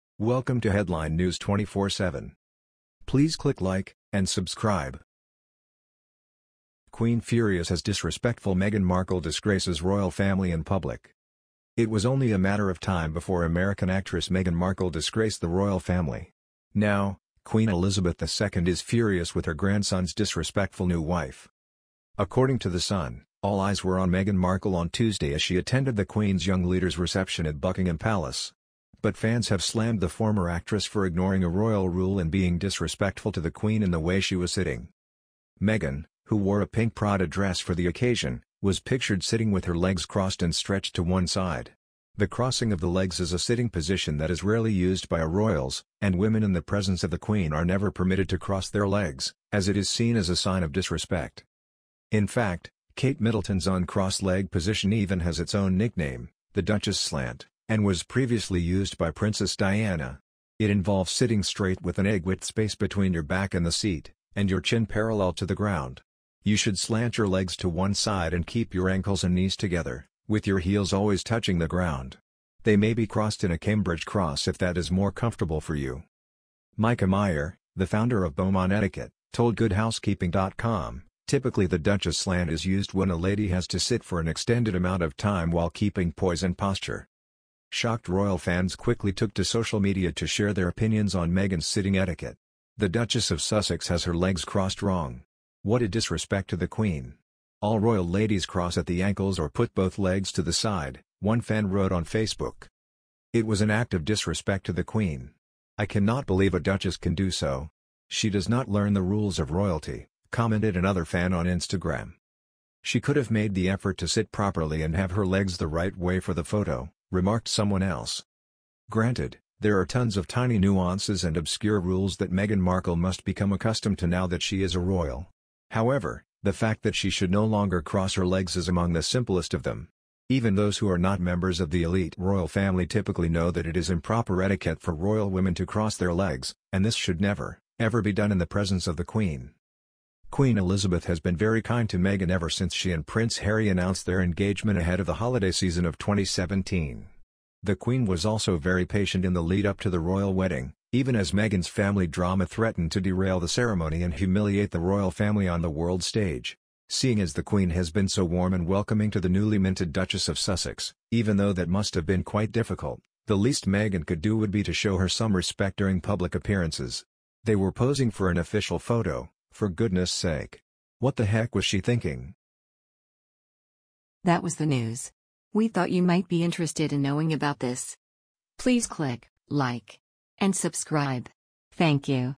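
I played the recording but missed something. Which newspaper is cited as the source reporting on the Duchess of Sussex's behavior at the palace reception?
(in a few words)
The Sun.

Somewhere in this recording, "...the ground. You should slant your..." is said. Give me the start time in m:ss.
1:05.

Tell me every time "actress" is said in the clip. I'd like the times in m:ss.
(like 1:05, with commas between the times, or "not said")
0:13, 0:30.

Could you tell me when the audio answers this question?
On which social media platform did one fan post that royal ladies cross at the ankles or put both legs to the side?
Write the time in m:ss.
1:42.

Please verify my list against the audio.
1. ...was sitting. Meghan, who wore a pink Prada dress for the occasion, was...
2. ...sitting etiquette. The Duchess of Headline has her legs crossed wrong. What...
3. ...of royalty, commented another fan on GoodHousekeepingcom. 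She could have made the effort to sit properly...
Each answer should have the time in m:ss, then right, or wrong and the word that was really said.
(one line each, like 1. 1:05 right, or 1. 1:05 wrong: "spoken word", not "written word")
1. 0:34 right
2. 1:31 wrong: "Sussex", not "Headline"
3. 1:49 wrong: "Instagram", not "GoodHousekeepingcom".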